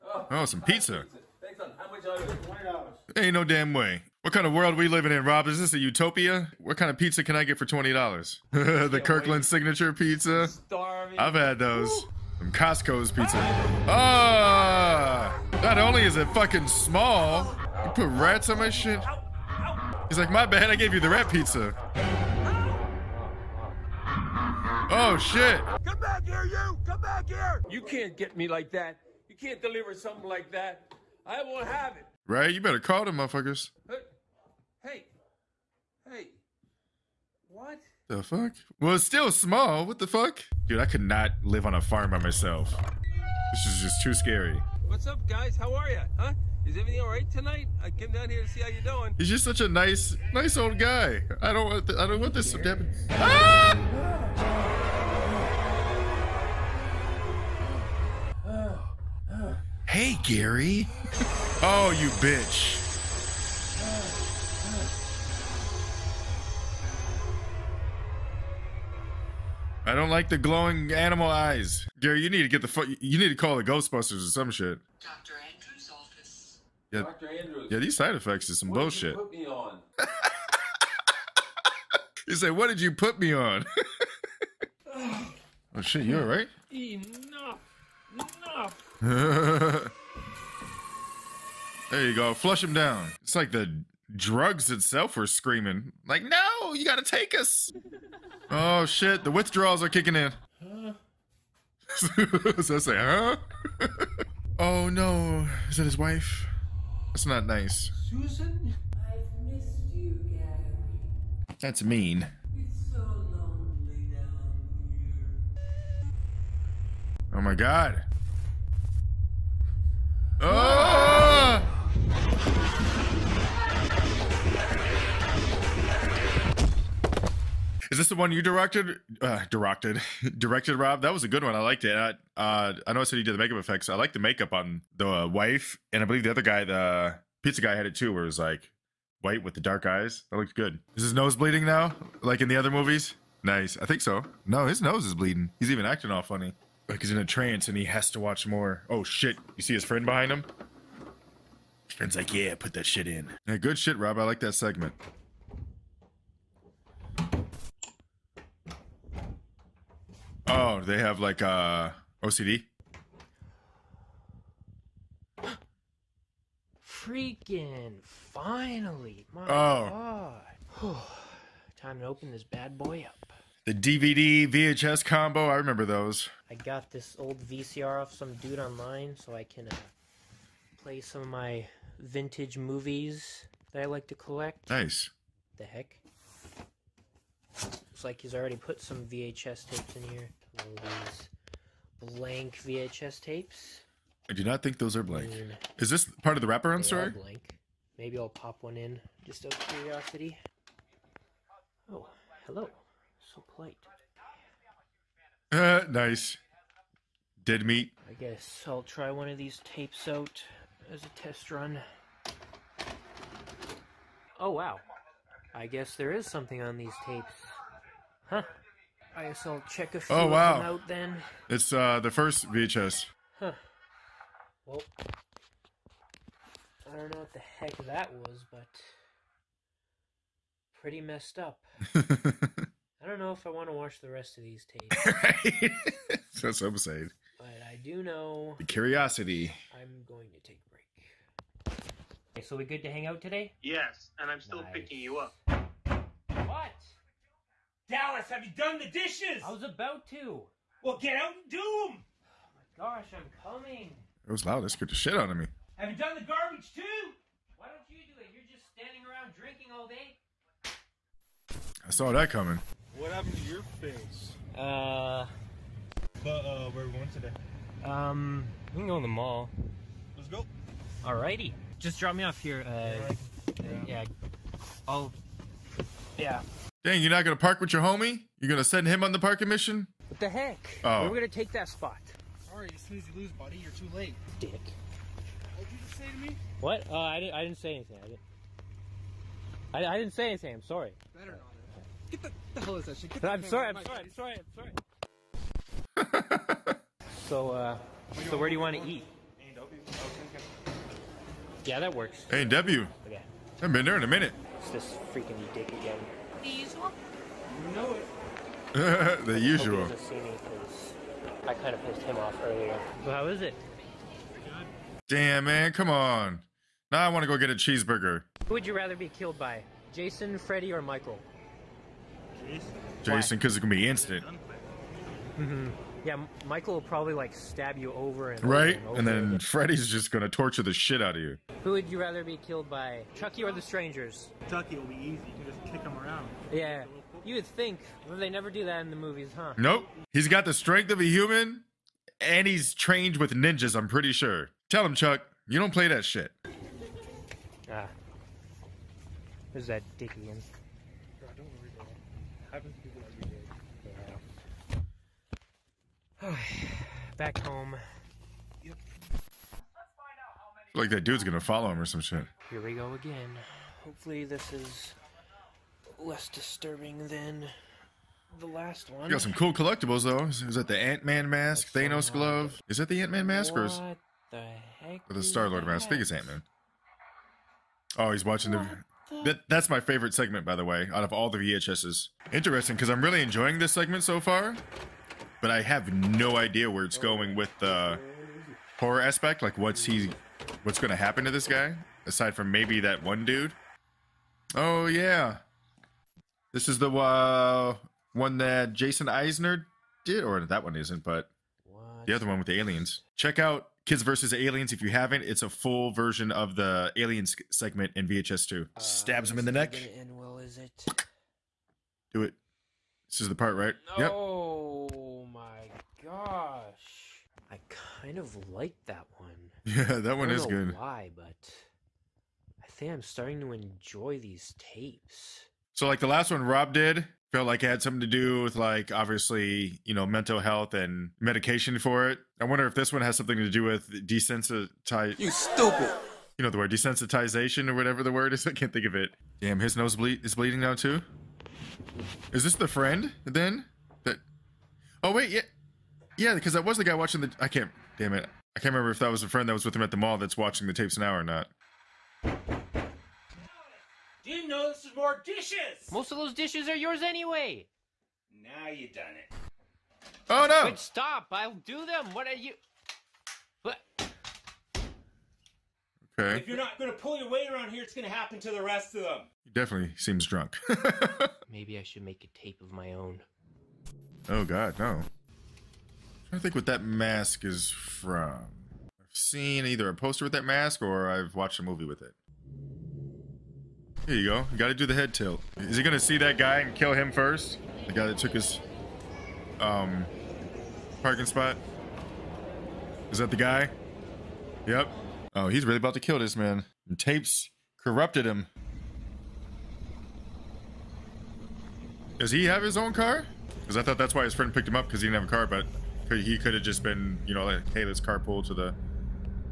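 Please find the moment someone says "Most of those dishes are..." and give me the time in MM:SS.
07:35.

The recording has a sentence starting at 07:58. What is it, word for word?
I've seen either a poster with that mask or I've watched a movie with it.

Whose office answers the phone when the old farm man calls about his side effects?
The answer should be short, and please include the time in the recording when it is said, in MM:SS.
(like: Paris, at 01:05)
Dr. Andrews, at 01:15.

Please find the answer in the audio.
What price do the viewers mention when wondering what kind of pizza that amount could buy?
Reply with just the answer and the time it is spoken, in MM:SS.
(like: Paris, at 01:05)
$20, at 00:07.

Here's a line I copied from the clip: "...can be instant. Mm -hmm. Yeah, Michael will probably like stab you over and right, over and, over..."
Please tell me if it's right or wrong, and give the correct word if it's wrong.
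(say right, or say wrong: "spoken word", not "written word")
right.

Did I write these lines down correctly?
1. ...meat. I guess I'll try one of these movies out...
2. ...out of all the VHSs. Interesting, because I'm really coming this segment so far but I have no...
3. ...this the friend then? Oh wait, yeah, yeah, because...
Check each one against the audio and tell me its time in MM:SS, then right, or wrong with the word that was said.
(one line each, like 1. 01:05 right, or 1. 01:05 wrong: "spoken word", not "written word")
1. 03:27 wrong: "tapes", not "movies"
2. 06:20 wrong: "enjoying", not "coming"
3. 07:22 right.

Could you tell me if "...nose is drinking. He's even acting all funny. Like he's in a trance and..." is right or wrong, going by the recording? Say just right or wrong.
wrong.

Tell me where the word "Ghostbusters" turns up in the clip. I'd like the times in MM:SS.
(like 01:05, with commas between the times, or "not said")
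01:13.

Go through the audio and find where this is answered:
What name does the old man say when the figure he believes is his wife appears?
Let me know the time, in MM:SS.
01:48.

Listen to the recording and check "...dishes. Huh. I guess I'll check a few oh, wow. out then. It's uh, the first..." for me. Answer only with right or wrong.
wrong.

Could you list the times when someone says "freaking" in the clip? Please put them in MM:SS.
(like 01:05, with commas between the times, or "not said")
02:46, 05:05.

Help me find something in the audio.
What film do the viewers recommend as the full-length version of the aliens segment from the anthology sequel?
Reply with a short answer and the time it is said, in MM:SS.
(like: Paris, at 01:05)
Kids versus Aliens, at 06:43.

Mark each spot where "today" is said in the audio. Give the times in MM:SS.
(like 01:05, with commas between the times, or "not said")
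04:03, 04:27.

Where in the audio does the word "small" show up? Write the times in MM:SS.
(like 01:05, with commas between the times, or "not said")
00:16, 00:39.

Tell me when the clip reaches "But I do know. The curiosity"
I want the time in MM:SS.
03:57.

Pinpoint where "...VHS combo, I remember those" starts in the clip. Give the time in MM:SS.
02:54.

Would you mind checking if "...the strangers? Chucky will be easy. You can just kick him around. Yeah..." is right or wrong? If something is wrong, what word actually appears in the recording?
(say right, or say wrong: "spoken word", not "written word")
right.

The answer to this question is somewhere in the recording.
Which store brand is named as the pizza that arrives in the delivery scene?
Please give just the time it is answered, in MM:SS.
00:09.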